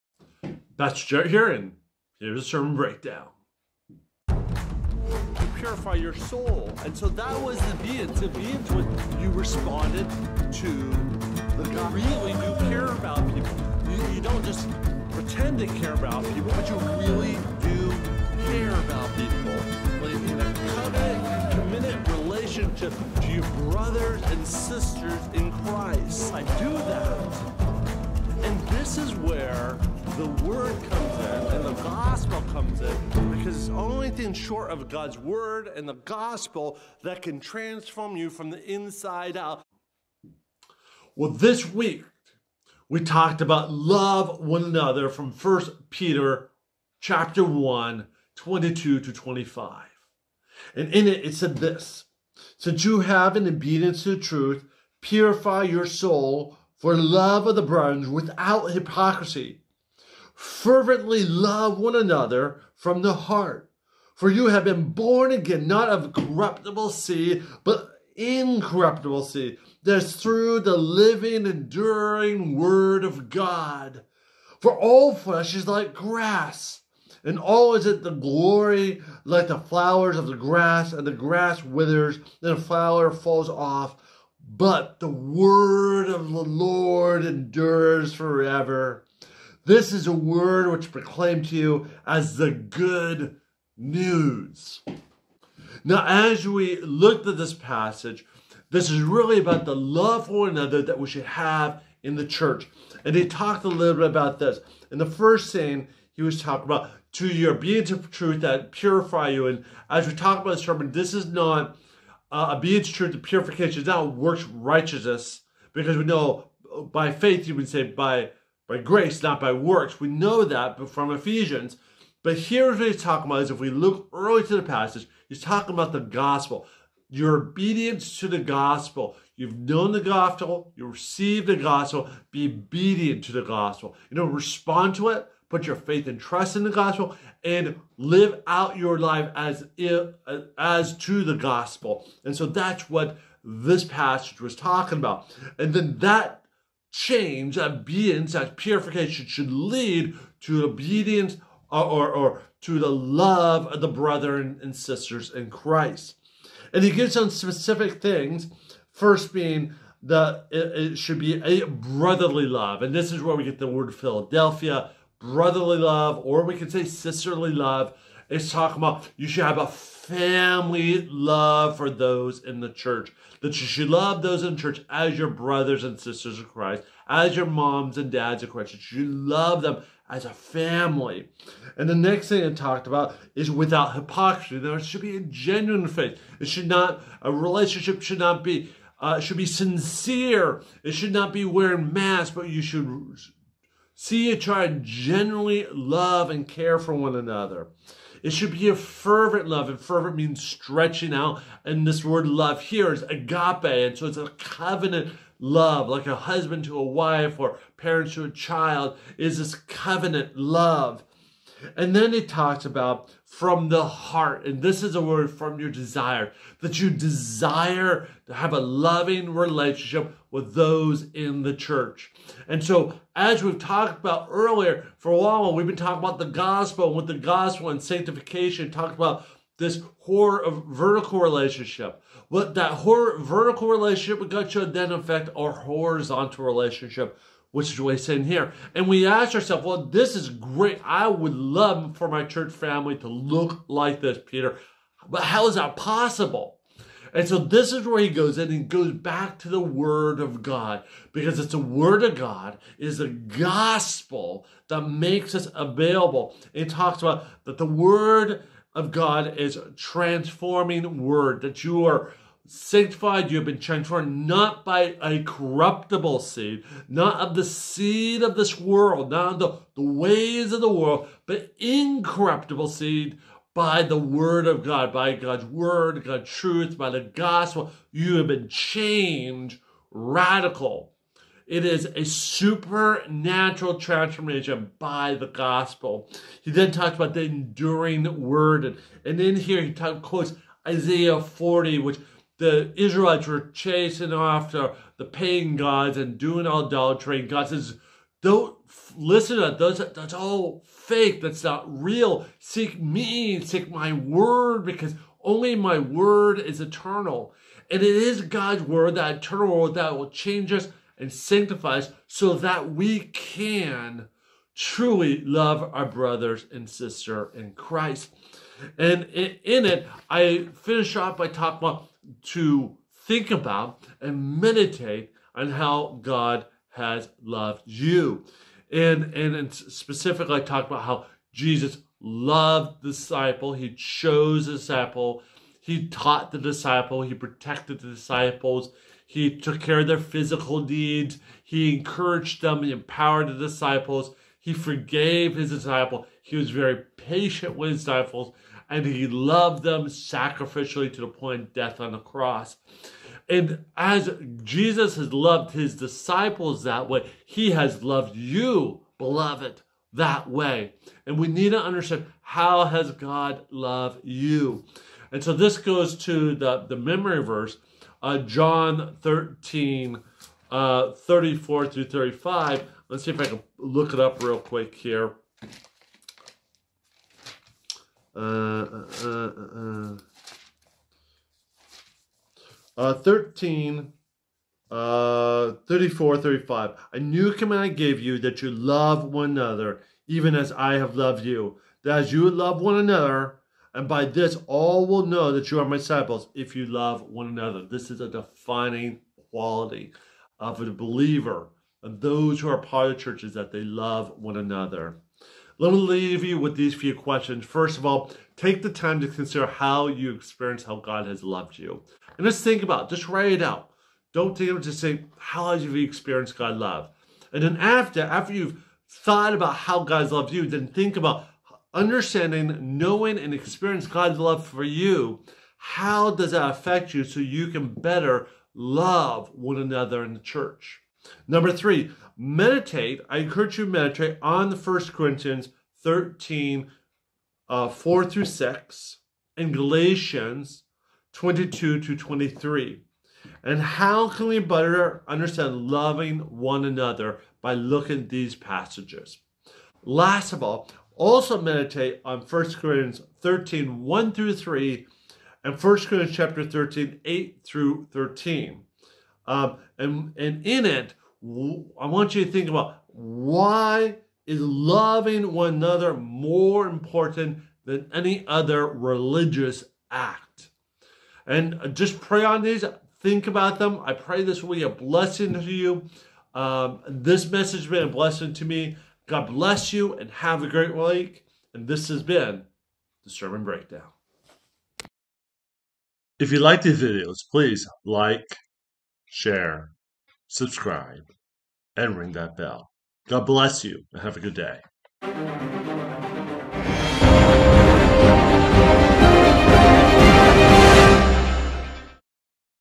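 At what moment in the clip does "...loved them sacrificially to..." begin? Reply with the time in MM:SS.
05:49.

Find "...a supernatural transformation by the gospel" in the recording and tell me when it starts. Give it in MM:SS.
04:41.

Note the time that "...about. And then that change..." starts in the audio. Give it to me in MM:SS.
02:24.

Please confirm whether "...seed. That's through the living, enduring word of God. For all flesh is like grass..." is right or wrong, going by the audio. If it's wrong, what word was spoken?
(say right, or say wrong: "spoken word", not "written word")
right.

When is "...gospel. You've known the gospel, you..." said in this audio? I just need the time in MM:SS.
02:08.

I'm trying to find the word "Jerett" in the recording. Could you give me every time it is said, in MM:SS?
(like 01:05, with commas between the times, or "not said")
00:01.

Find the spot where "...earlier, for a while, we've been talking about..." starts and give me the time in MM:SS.
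03:44.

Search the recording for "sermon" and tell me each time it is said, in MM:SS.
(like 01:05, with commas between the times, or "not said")
00:02, 01:50, 08:03.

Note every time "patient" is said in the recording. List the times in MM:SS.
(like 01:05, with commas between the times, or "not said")
05:46.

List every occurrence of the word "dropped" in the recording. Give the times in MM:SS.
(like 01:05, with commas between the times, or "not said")
not said.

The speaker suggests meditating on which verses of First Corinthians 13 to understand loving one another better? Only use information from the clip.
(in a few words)
4 through 6.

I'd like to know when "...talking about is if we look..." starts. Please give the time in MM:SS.
02:03.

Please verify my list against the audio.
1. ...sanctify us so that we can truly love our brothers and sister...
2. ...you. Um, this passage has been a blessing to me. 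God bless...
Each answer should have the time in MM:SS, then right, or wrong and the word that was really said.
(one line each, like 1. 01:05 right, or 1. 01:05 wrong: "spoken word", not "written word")
1. 05:11 right
2. 07:55 wrong: "message", not "passage".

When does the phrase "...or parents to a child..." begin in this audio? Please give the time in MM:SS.
03:27.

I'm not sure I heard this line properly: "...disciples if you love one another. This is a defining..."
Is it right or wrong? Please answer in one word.
right.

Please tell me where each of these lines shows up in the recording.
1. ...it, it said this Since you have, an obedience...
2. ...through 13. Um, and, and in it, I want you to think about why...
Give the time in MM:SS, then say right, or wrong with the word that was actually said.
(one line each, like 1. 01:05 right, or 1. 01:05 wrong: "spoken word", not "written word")
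1. 00:51 right
2. 07:37 right.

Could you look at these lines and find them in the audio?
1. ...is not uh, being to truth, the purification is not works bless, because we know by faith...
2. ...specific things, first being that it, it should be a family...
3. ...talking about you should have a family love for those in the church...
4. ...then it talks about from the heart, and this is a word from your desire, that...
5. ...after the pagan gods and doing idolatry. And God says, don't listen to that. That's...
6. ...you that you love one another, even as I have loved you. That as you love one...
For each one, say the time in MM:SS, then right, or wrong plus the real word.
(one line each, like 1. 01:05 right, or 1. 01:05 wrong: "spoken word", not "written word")
1. 01:51 wrong: "righteousness", not "bless"
2. 02:37 wrong: "brotherly", not "family"
3. 02:48 right
4. 03:31 right
5. 04:54 right
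6. 06:28 right.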